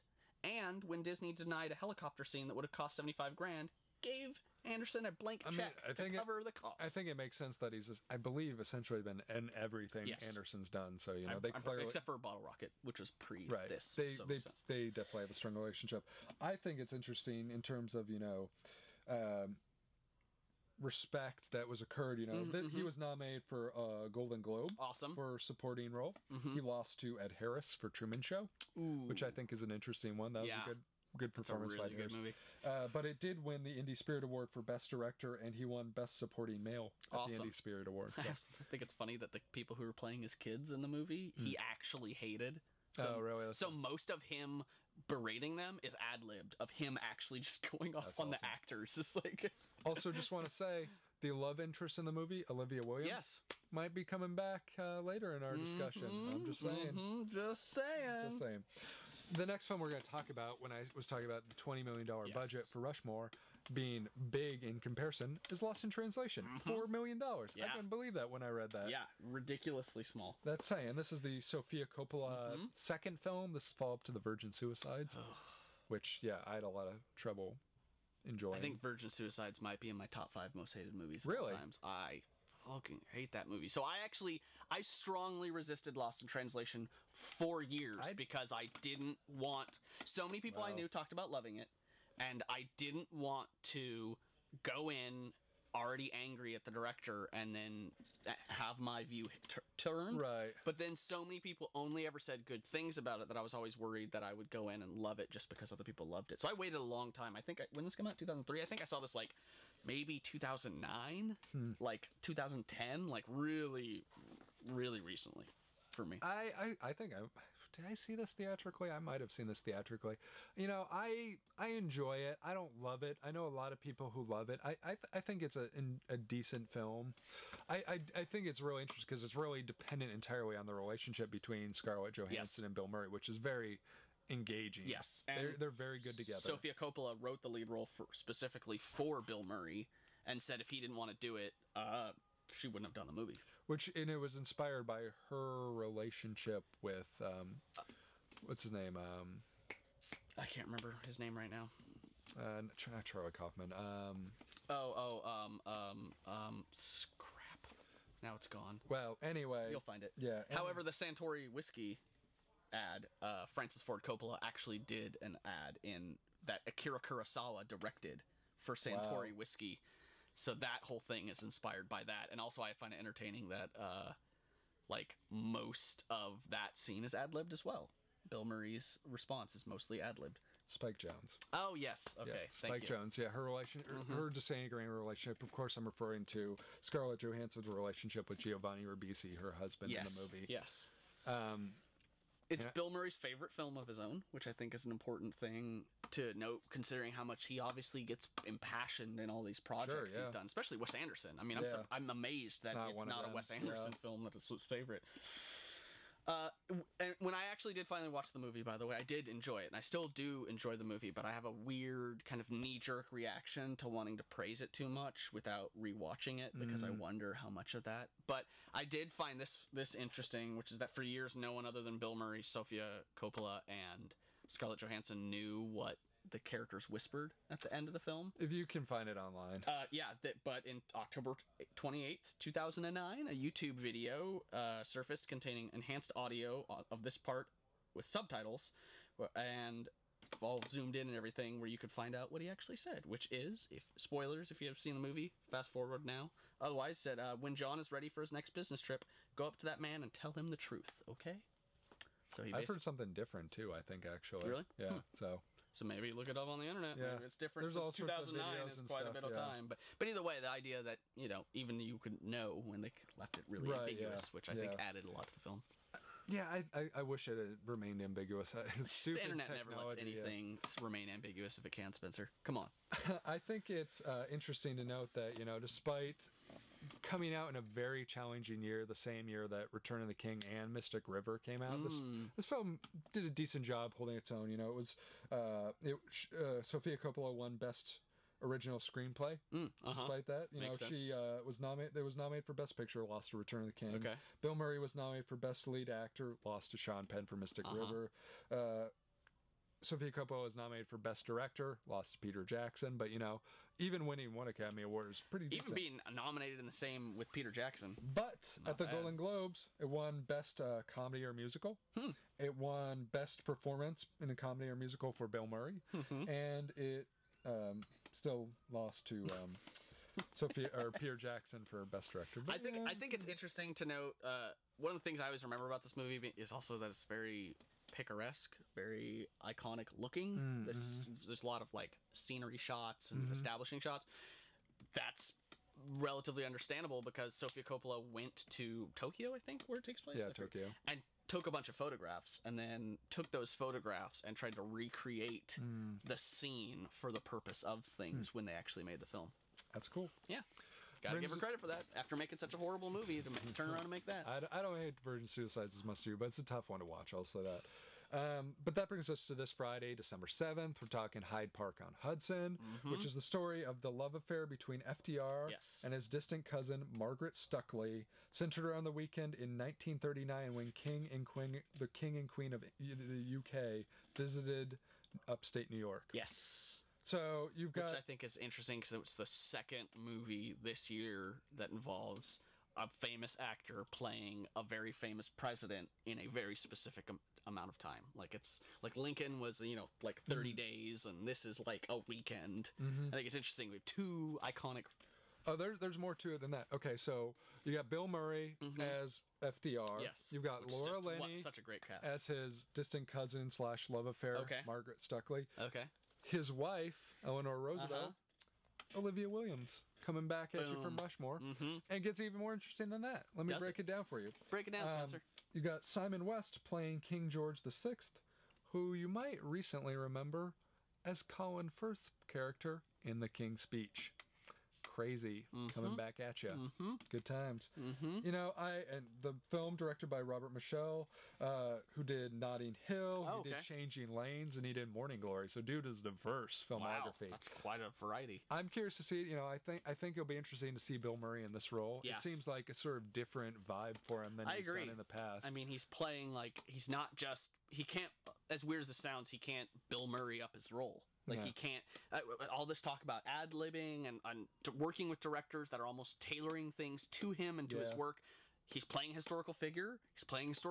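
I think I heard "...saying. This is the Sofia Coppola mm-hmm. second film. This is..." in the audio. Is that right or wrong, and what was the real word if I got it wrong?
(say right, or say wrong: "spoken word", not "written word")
right.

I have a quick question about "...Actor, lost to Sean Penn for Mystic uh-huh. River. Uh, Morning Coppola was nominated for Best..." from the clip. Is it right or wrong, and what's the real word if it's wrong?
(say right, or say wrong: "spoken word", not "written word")
wrong: "Sofia", not "Morning".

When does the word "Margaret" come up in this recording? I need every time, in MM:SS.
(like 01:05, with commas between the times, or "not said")
06:06, 06:44.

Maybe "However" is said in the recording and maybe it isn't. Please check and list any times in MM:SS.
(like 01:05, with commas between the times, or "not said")
02:40.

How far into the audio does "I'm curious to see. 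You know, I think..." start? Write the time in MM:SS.
07:18.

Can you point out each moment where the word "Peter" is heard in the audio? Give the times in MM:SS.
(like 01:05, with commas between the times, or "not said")
05:02, 05:07, 05:20.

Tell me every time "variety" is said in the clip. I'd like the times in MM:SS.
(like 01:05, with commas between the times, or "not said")
07:17.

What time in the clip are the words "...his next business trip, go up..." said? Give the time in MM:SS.
04:08.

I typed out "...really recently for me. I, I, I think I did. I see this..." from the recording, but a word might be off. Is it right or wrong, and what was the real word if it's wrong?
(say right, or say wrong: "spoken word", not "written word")
right.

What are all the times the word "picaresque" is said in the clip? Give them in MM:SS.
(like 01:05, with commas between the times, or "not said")
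05:27.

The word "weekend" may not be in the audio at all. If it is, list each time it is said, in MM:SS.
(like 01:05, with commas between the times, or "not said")
06:08, 06:31.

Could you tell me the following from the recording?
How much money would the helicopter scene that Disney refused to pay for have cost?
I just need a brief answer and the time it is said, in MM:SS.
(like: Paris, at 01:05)
75 grand, at 00:02.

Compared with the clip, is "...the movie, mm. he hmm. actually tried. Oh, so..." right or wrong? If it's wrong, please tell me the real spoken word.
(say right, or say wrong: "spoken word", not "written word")
wrong: "hated", not "tried".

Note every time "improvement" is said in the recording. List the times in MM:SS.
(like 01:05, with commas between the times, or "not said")
not said.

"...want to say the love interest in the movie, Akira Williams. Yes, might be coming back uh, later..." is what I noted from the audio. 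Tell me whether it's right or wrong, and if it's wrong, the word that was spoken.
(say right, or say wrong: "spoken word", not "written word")
wrong: "Olivia", not "Akira".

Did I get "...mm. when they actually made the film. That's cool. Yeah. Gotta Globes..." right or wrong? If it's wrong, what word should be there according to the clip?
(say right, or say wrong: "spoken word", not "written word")
wrong: "Virgin", not "Globes".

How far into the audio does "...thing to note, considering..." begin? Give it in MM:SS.
03:15.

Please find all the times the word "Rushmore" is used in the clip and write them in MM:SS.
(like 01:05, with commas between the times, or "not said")
01:02, 06:50.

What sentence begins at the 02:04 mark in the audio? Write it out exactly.
I I, th- I think it's a a decent film.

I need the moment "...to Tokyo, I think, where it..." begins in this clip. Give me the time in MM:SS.
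05:38.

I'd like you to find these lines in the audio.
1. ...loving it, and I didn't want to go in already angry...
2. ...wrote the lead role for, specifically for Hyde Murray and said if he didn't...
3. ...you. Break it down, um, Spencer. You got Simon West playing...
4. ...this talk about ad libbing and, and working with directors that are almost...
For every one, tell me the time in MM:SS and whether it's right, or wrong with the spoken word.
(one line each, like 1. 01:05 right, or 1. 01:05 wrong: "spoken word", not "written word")
1. 01:31 right
2. 02:17 wrong: "Bill", not "Hyde"
3. 06:54 right
4. 07:32 right.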